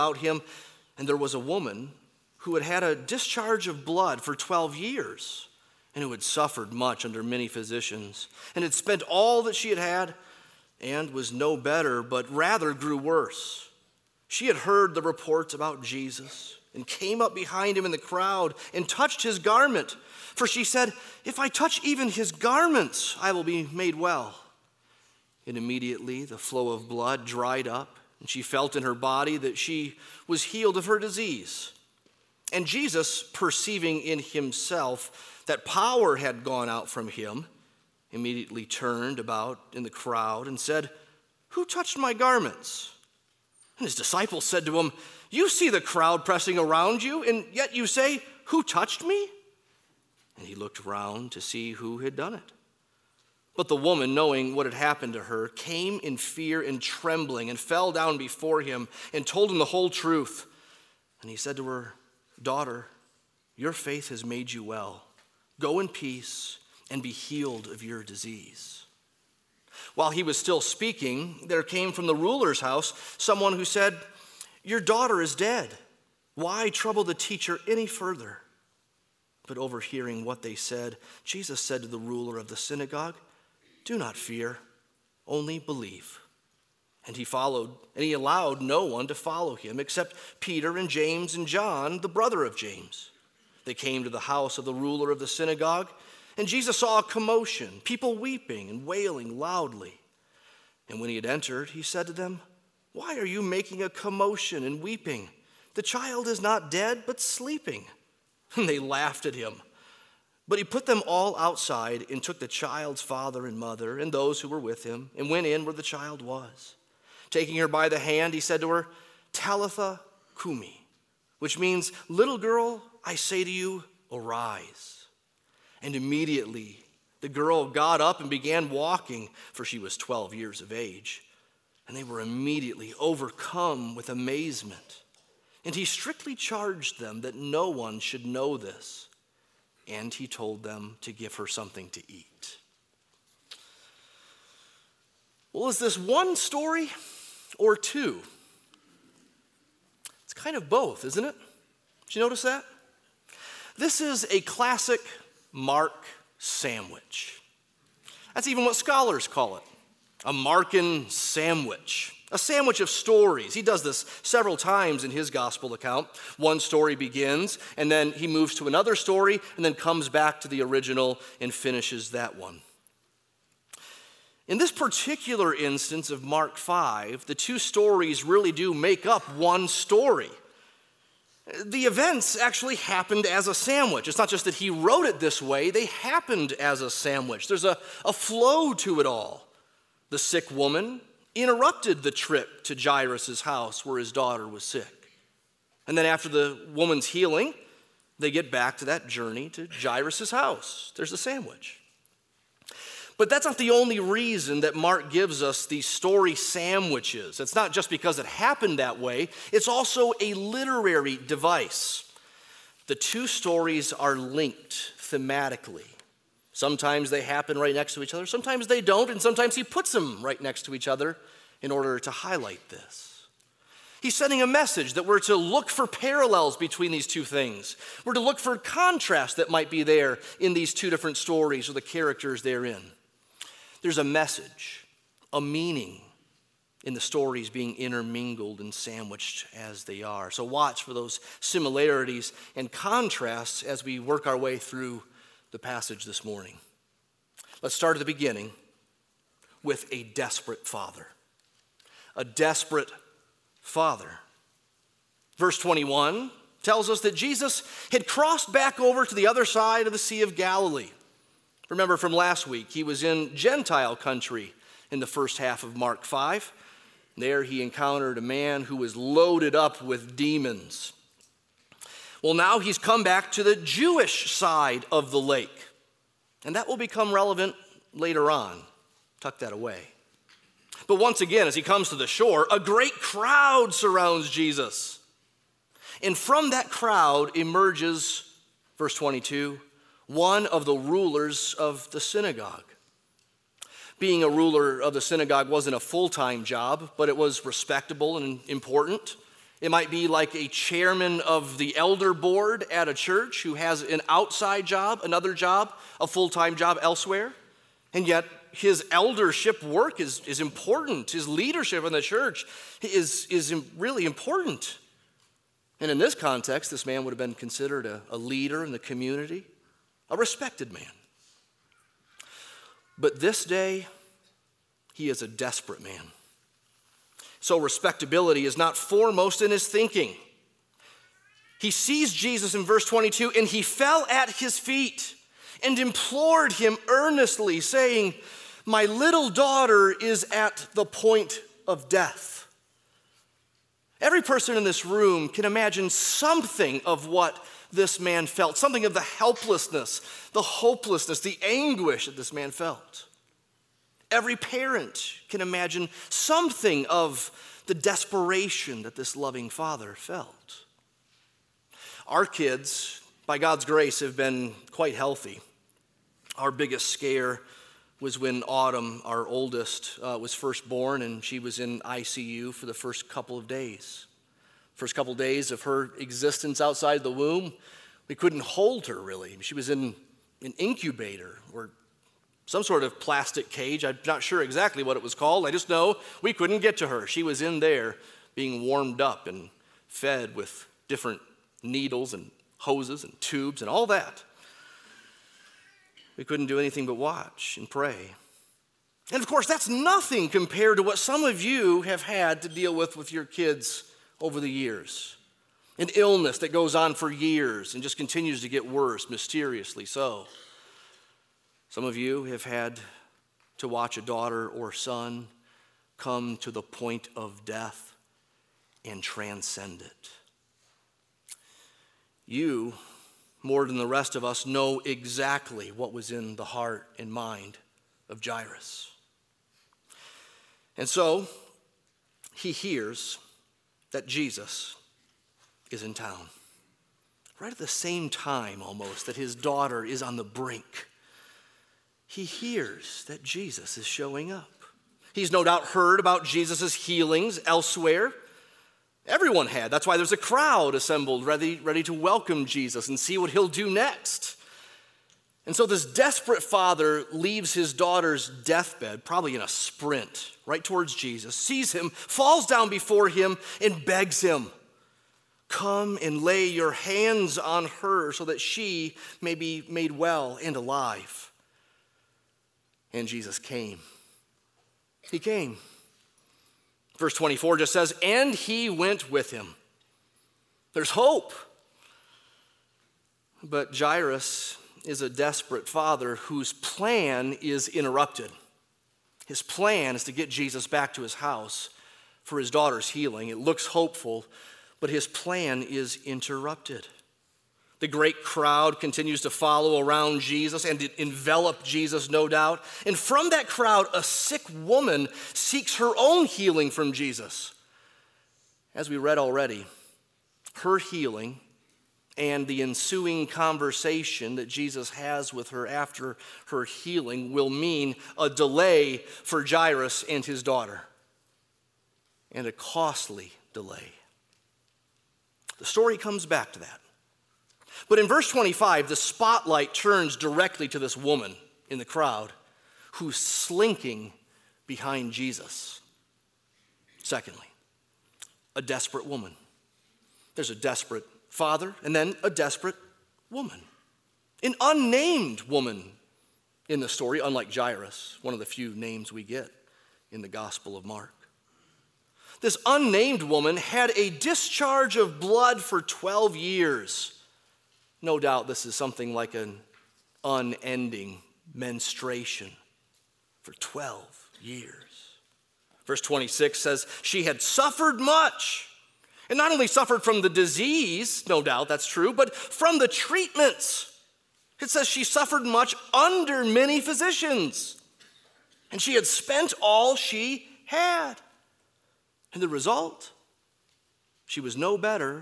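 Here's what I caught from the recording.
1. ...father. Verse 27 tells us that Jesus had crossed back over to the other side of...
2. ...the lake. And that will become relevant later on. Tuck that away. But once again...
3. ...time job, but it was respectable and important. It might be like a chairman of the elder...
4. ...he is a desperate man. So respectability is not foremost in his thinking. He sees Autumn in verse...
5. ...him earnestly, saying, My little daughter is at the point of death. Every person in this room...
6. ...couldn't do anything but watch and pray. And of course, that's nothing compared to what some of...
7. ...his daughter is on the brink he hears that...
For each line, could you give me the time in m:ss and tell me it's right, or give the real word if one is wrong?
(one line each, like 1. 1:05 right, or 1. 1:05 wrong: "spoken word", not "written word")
1. 4:13 wrong: "21", not "27"
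2. 4:35 right
3. 4:56 right
4. 5:24 wrong: "Jesus", not "Autumn"
5. 5:36 right
6. 6:36 right
7. 7:19 right.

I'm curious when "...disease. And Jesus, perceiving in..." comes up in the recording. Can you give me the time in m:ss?
0:30.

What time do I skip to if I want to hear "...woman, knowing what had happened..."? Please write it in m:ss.
0:53.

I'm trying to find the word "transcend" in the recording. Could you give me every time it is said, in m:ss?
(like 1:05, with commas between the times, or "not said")
6:59.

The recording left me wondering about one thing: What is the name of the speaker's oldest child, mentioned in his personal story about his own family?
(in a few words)
Autumn.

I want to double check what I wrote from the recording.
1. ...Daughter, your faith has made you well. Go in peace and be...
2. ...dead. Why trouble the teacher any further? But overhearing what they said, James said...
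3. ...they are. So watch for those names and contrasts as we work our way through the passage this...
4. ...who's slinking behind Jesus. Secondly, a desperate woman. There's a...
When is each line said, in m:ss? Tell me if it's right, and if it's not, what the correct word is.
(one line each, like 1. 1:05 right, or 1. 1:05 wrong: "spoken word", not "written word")
1. 1:02 right
2. 1:15 wrong: "Jesus", not "James"
3. 3:59 wrong: "similarities", not "names"
4. 8:52 right.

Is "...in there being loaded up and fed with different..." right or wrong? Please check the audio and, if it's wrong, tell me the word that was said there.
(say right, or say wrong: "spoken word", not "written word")
wrong: "warmed", not "loaded".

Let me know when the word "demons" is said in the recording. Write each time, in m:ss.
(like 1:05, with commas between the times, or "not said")
4:30.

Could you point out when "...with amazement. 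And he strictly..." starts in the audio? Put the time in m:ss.
2:13.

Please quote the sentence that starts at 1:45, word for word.
The child is not dead, but sleeping.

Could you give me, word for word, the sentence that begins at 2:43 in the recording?
He does this several times in his gospel account.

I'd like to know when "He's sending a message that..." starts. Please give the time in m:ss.
3:44.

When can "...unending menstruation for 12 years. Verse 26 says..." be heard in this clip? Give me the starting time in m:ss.
9:20.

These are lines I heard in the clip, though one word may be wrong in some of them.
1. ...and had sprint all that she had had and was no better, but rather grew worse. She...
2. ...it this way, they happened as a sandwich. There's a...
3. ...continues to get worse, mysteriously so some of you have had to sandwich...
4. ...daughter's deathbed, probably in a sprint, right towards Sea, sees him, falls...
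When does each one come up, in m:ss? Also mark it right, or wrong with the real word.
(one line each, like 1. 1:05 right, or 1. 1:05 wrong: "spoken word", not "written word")
1. 0:08 wrong: "spent", not "sprint"
2. 3:05 right
3. 6:47 wrong: "watch", not "sandwich"
4. 7:37 wrong: "Jesus", not "Sea".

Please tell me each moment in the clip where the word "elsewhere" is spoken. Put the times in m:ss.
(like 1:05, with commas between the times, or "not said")
5:06, 7:27.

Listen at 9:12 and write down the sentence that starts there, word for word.
This unnamed woman had a discharge of blood for 12 years.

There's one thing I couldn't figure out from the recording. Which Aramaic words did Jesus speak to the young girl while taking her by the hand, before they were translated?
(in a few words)
Talitha cumi.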